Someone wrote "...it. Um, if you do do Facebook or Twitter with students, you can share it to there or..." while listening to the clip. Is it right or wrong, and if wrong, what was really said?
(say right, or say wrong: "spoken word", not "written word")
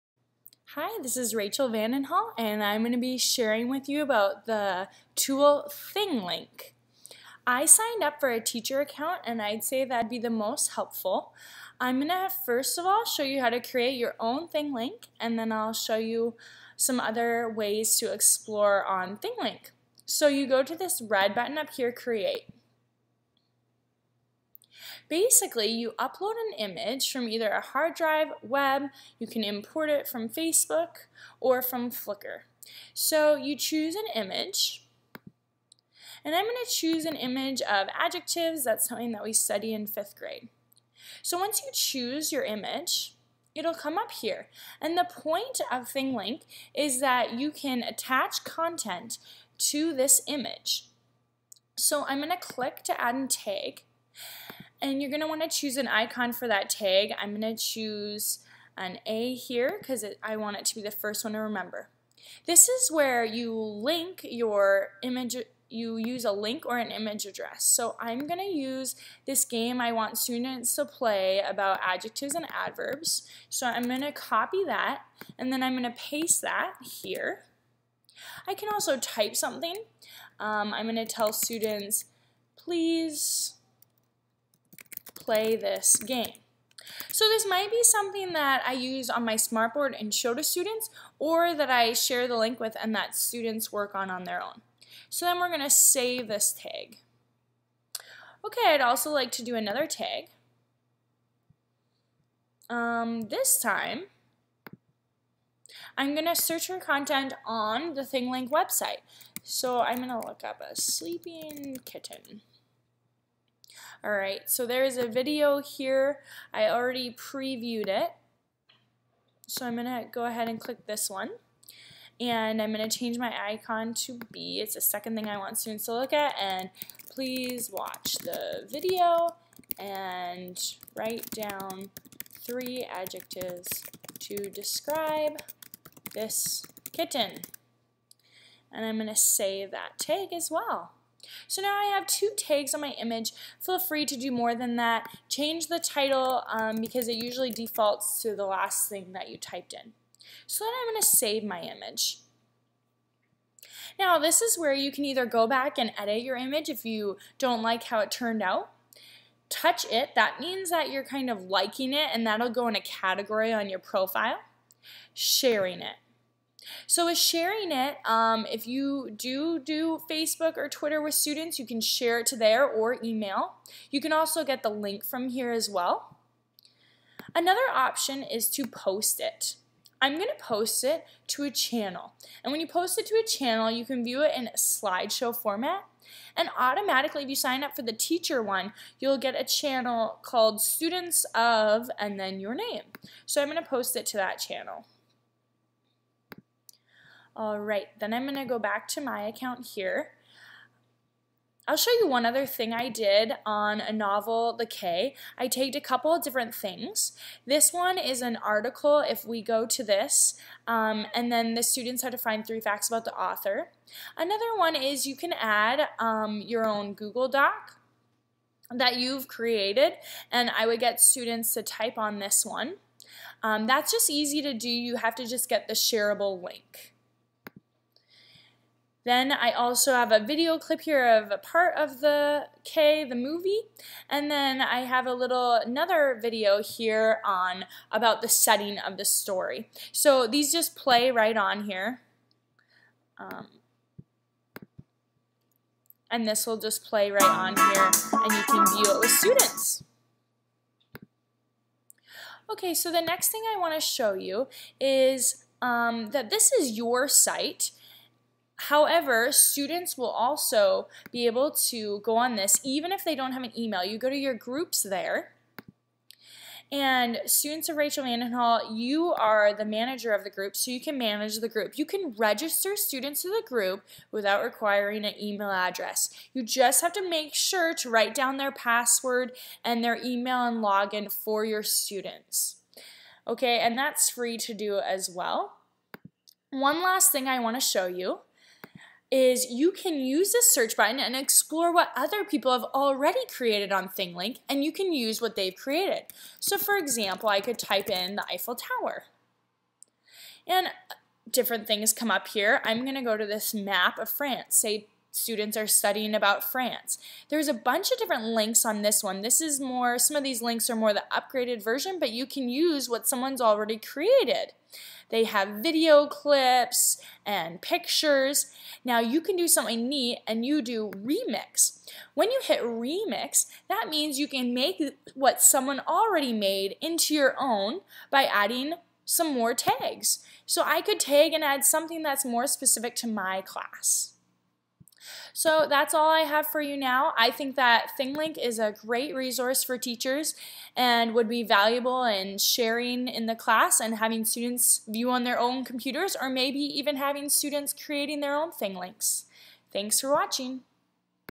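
right.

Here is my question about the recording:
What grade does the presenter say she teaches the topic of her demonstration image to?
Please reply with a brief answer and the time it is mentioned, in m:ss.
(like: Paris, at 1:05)
Fifth grade, at 0:39.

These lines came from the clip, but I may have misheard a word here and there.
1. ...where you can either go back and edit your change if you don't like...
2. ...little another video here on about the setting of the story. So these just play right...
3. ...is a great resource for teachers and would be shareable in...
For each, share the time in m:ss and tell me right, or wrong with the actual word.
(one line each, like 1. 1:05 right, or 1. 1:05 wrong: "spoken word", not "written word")
1. 2:34 wrong: "image", not "change"
2. 3:55 right
3. 5:38 wrong: "valuable", not "shareable".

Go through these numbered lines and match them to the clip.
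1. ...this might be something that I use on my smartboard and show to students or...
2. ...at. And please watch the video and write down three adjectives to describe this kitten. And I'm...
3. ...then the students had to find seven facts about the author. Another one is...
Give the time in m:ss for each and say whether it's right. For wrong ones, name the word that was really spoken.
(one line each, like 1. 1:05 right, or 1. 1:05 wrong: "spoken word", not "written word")
1. 1:27 right
2. 2:06 right
3. 3:31 wrong: "three", not "seven".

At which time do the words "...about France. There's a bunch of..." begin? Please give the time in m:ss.
5:06.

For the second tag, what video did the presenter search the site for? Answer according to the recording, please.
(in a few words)
A sleeping kitten.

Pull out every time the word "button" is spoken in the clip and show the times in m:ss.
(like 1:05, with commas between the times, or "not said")
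0:21, 4:50.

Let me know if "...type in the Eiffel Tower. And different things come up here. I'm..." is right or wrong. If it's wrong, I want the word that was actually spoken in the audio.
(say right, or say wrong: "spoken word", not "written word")
right.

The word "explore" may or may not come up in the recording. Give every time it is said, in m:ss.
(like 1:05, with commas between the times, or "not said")
0:18, 4:51.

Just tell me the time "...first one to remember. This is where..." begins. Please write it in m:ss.
1:00.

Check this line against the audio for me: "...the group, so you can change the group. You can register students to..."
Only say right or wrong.
wrong.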